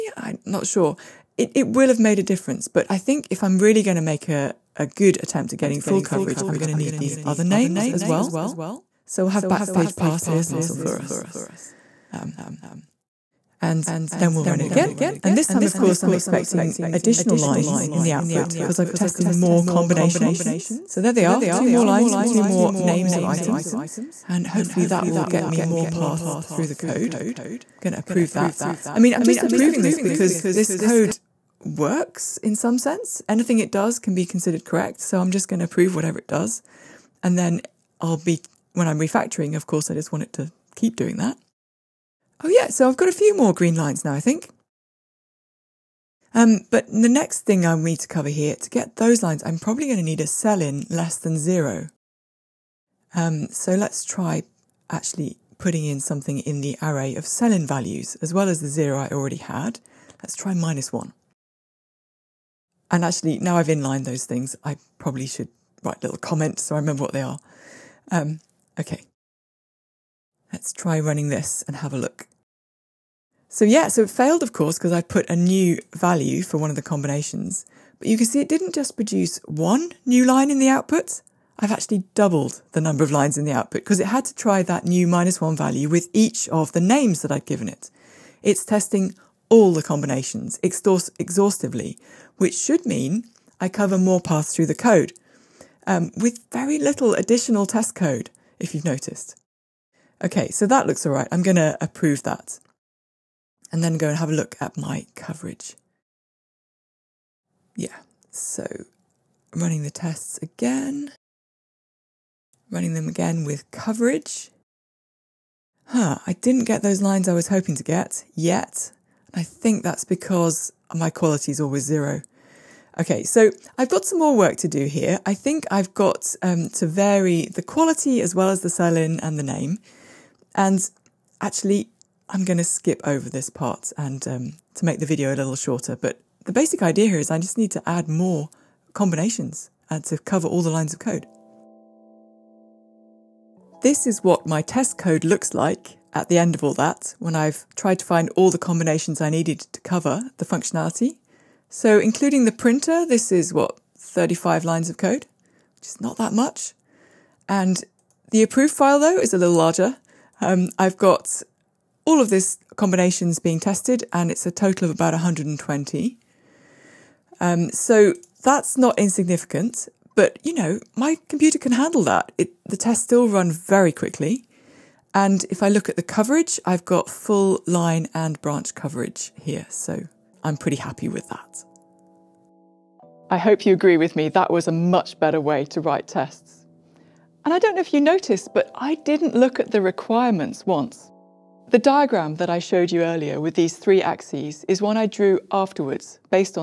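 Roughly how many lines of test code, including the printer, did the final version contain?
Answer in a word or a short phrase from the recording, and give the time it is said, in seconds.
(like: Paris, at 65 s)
35, at 153 s.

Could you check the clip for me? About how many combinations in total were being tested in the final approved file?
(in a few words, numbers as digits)
120.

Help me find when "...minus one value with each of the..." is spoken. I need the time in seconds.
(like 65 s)
85 s.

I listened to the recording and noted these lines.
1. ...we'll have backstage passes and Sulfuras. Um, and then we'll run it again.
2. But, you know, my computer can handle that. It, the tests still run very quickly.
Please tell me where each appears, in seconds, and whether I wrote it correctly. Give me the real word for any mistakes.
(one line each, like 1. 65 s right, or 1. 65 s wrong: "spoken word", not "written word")
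1. 9 s right
2. 170 s right.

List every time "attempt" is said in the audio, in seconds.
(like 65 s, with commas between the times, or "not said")
5 s.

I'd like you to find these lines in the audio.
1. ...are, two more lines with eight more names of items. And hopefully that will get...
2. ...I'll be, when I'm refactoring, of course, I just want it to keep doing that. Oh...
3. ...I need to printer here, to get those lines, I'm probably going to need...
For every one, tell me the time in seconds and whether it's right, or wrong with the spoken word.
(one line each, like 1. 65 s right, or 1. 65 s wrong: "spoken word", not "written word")
1. 21 s wrong: "two", not "eight"
2. 38 s right
3. 47 s wrong: "cover", not "printer".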